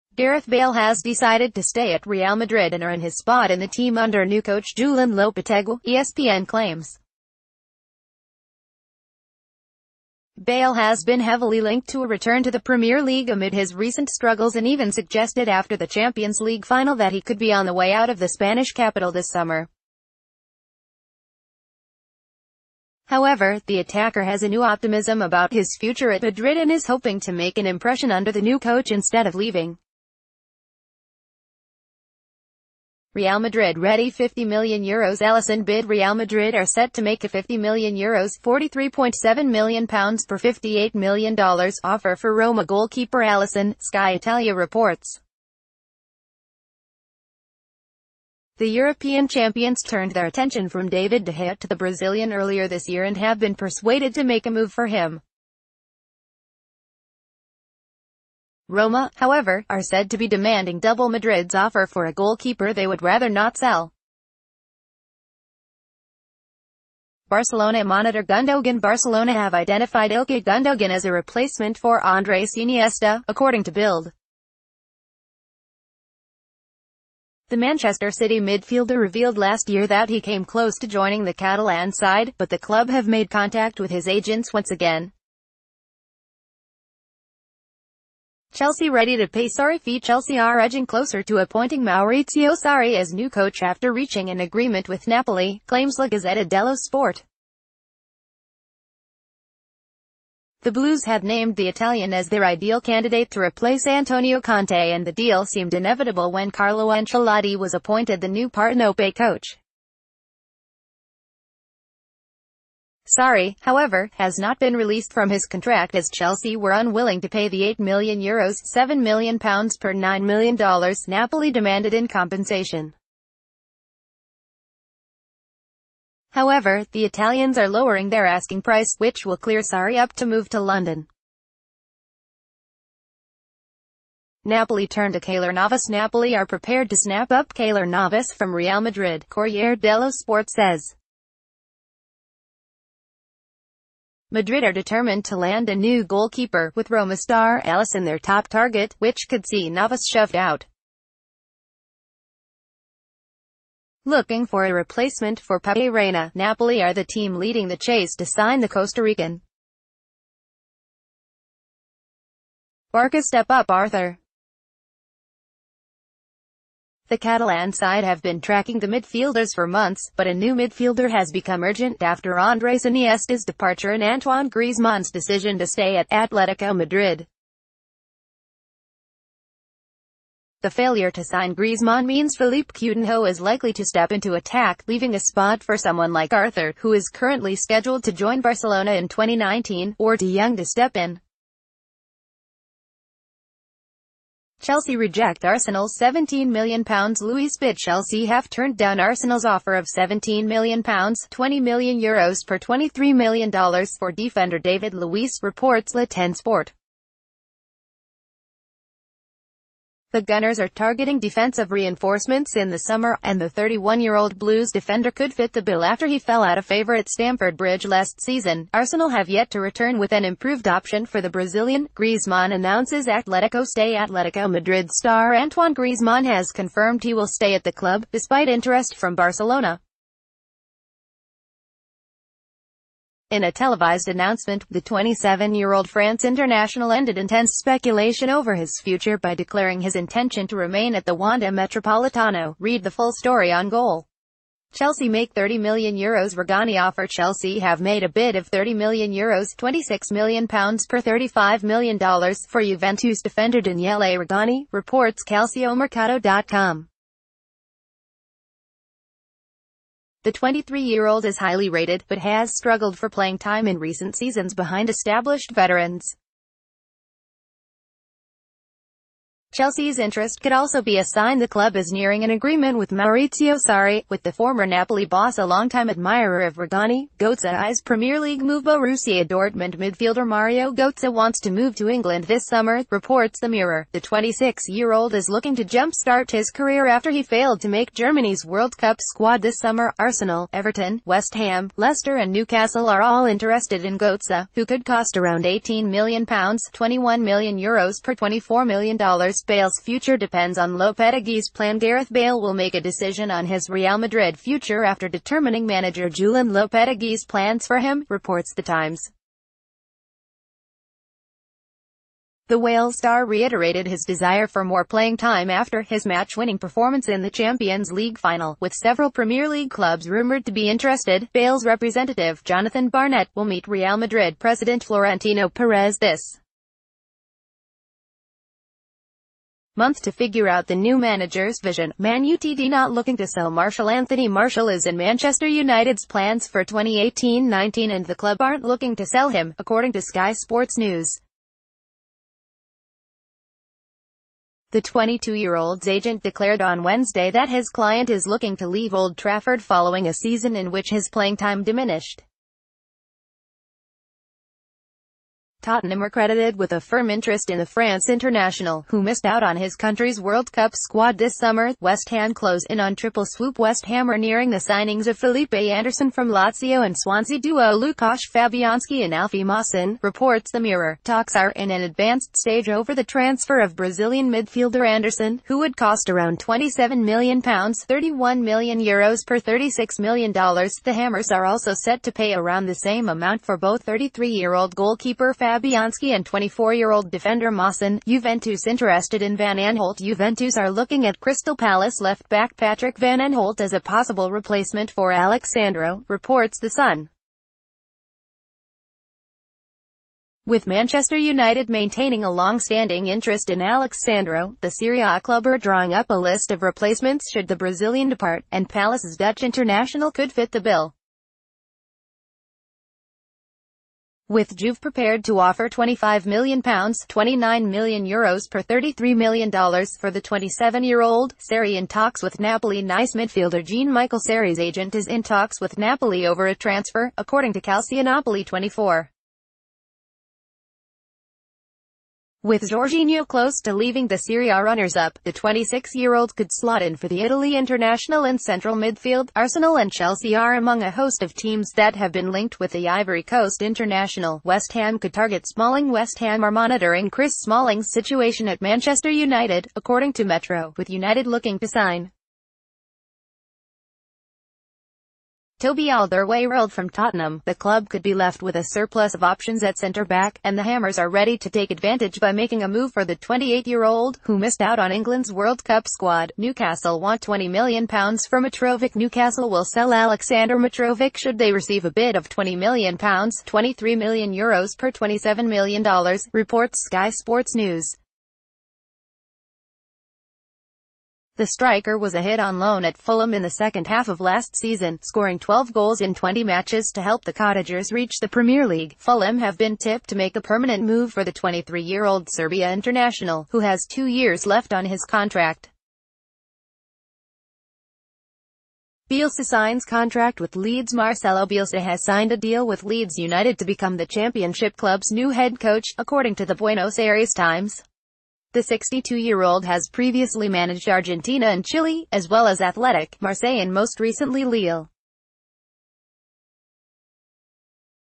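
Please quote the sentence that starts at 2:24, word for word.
Madrid are determined to land a new goalkeeper, with Roma star Alisson their top target, which could see Navas shoved out.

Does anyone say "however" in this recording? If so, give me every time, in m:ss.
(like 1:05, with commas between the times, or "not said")
0:23, 0:59, 1:53, 2:06.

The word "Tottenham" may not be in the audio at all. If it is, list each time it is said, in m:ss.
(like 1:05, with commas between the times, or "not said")
5:55, 7:36.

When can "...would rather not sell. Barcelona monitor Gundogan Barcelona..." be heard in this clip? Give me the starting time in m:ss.
1:02.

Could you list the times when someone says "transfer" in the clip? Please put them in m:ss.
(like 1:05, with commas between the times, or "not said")
6:13, 7:06.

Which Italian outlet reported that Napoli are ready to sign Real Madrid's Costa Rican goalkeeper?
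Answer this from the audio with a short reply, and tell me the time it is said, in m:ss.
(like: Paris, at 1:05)
Corriere dello Sport, at 2:19.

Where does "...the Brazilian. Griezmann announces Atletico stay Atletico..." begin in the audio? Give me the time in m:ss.
3:41.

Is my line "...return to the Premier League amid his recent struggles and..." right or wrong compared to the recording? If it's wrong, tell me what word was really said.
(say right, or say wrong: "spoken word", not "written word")
right.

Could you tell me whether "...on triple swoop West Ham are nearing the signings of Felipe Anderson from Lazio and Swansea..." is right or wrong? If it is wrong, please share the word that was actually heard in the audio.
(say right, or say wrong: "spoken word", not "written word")
right.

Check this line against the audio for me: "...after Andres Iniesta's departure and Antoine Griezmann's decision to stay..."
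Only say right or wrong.
right.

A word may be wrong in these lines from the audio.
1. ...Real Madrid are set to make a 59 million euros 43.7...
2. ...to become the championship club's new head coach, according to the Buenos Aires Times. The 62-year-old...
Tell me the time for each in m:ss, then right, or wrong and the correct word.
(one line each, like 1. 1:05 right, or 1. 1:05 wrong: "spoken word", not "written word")
1. 0:35 wrong: "50", not "59"
2. 8:23 right.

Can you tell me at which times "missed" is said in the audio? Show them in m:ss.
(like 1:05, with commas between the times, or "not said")
5:59, 7:44.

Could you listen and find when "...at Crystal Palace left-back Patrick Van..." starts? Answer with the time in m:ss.
6:31.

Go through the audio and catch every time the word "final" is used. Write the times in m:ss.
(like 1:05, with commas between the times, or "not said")
0:16, 5:18.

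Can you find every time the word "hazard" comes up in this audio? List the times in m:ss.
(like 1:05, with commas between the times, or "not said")
not said.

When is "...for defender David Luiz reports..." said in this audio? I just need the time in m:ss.
3:23.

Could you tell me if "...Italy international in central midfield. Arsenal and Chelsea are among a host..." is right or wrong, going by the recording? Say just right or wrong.
right.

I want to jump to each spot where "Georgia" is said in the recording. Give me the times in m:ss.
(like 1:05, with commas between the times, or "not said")
not said.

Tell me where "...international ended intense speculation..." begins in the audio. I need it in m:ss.
3:56.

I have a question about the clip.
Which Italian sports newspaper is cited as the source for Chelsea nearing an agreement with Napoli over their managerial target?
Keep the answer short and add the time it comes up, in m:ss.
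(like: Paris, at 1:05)
La Gazzetta dello Sport, at 1:35.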